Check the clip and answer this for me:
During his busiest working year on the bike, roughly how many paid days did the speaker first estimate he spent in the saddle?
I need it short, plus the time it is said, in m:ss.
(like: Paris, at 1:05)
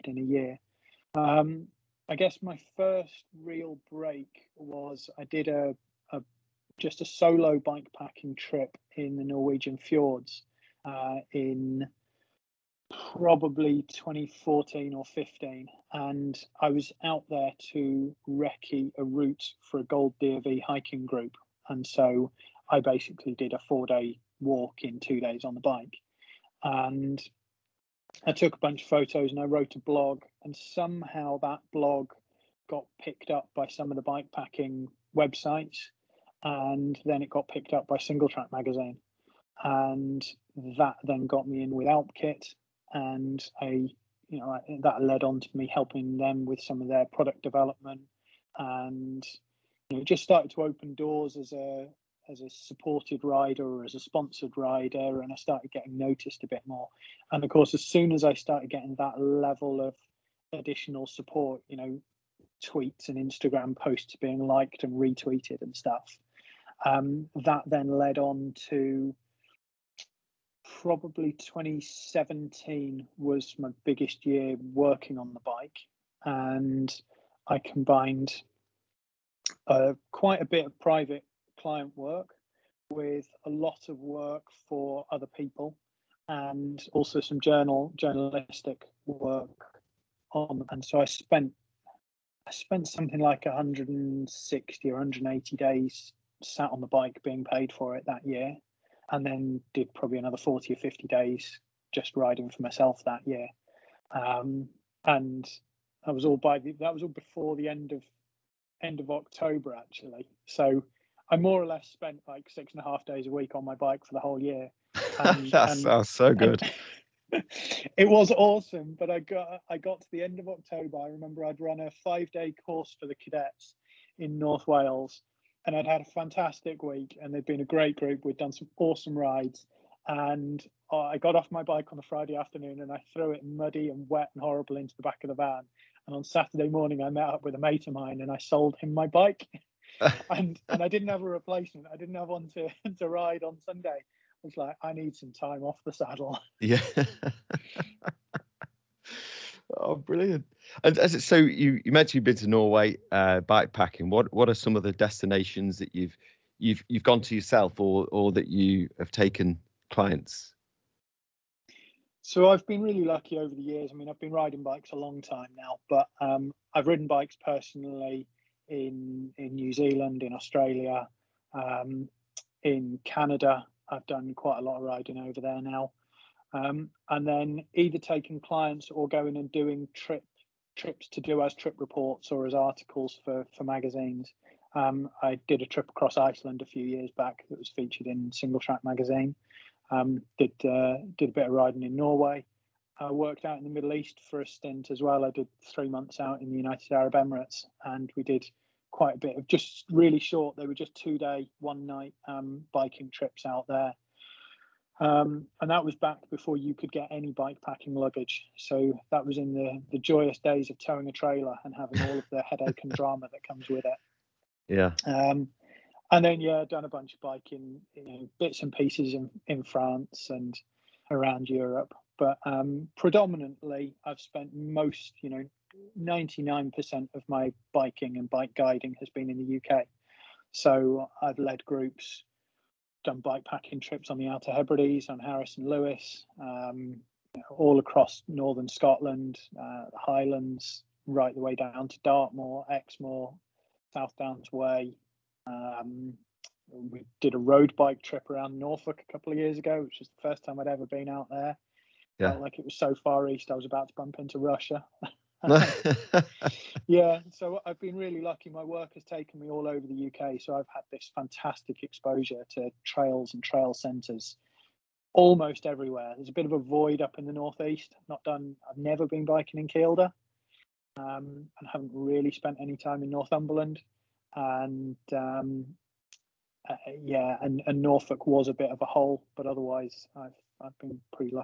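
160, at 1:33.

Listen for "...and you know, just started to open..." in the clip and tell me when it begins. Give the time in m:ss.
0:48.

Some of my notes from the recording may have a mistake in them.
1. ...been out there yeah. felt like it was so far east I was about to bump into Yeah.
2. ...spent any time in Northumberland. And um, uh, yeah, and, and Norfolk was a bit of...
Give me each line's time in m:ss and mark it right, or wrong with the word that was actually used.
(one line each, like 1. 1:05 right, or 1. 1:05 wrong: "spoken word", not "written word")
1. 4:10 wrong: "Russia", not "Yeah"
2. 4:32 right.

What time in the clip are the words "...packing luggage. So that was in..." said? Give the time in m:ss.
3:27.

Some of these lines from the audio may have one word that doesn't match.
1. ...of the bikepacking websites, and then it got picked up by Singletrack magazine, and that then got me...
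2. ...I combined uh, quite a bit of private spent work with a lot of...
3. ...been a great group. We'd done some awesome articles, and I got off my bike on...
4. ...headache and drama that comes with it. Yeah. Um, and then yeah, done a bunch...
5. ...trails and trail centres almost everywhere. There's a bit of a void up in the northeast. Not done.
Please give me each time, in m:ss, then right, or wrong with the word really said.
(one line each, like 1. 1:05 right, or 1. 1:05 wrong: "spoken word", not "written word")
1. 0:33 right
2. 1:17 wrong: "client", not "spent"
3. 2:07 wrong: "rides", not "articles"
4. 3:32 right
5. 4:22 right.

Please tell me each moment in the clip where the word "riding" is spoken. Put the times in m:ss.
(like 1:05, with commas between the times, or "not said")
1:42, 2:44, 2:54, 3:11.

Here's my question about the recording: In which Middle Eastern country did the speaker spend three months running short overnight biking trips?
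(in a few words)
United Arab Emirates.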